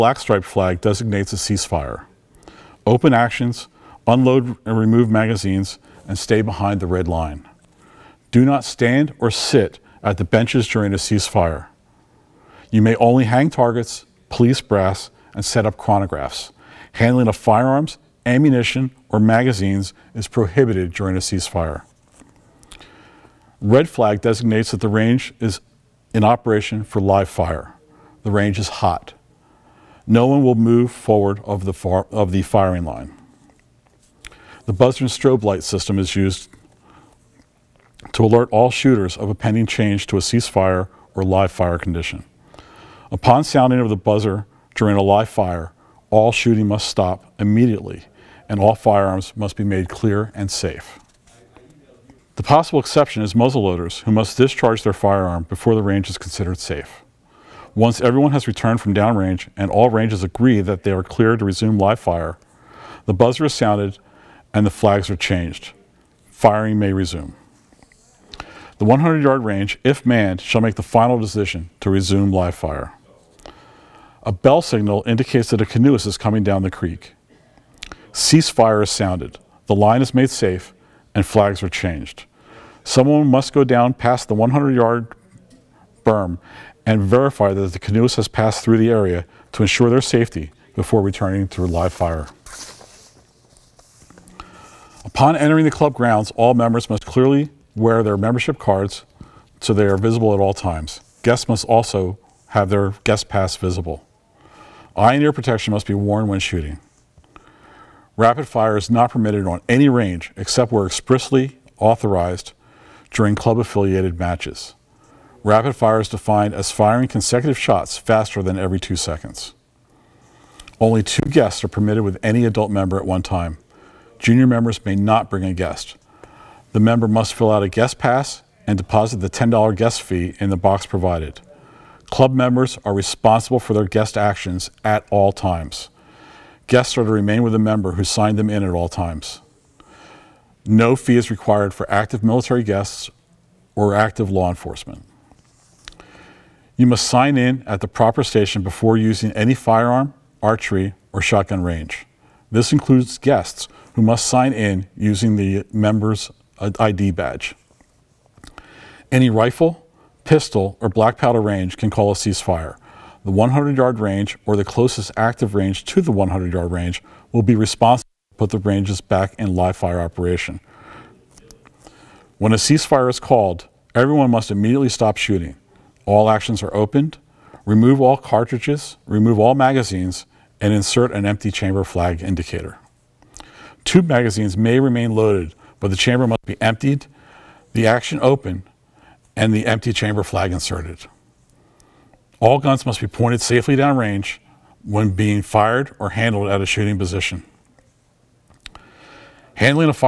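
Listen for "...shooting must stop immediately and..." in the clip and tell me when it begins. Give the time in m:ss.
0:46.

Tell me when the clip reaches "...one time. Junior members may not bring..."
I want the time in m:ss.
2:03.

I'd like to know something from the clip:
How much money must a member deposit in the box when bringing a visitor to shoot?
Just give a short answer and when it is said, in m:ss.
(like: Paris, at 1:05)
$10, at 2:09.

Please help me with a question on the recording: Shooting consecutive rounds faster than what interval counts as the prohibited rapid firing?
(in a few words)
Every 2 seconds.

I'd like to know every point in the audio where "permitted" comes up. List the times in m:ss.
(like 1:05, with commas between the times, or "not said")
1:49, 2:01.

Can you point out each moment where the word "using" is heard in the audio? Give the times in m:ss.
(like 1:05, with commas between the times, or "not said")
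2:28, 2:34.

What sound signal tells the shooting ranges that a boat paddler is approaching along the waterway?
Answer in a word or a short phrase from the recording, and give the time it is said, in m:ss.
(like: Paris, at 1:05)
A bell, at 1:14.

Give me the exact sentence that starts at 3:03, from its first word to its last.
Tube magazines may remain loaded, but the chamber must be emptied, the action open, and the empty chamber flag inserted.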